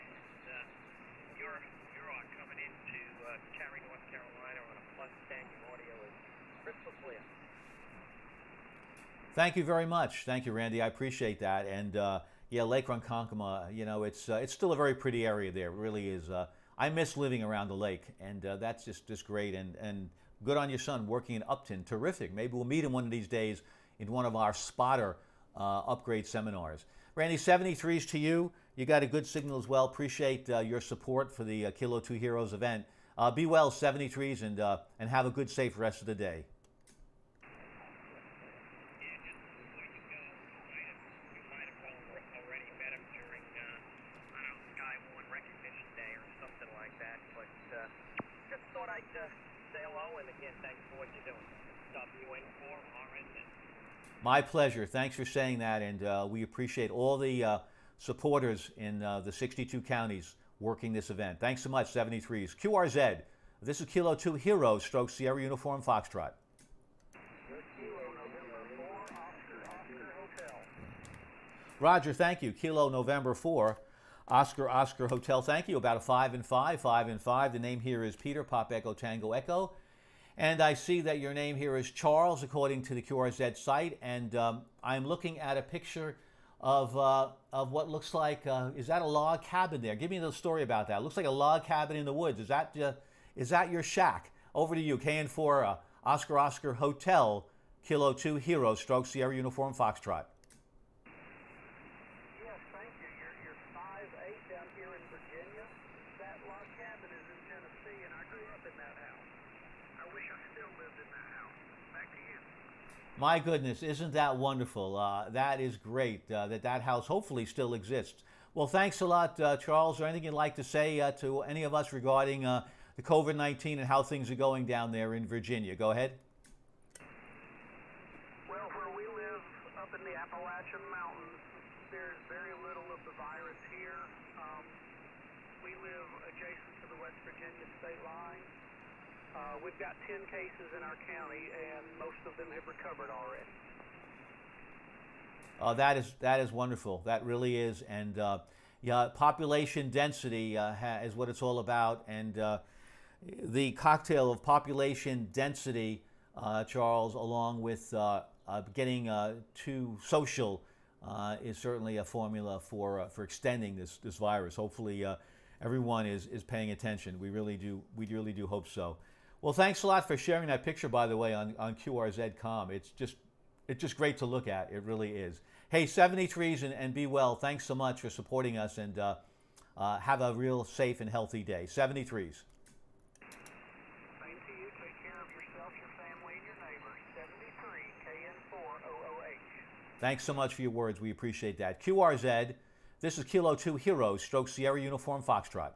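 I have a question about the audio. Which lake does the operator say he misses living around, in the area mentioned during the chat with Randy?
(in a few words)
Lake Ronkonkoma.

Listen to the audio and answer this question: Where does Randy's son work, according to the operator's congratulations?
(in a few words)
Upton.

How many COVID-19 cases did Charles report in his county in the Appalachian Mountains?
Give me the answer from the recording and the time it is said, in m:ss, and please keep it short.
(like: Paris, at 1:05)
10, at 2:20.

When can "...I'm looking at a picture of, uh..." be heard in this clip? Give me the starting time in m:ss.
1:24.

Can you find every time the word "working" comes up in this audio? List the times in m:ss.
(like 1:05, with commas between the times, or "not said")
0:21, 1:00.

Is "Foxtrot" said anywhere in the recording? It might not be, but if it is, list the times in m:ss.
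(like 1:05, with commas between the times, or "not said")
1:05, 1:39, 3:15.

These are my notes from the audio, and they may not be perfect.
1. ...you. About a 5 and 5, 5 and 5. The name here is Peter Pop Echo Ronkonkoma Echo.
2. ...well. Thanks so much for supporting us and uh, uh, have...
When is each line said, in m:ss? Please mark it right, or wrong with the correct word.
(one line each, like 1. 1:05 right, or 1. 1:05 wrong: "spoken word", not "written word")
1. 1:15 wrong: "Tango", not "Ronkonkoma"
2. 2:57 right.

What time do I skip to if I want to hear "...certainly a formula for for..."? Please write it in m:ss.
2:41.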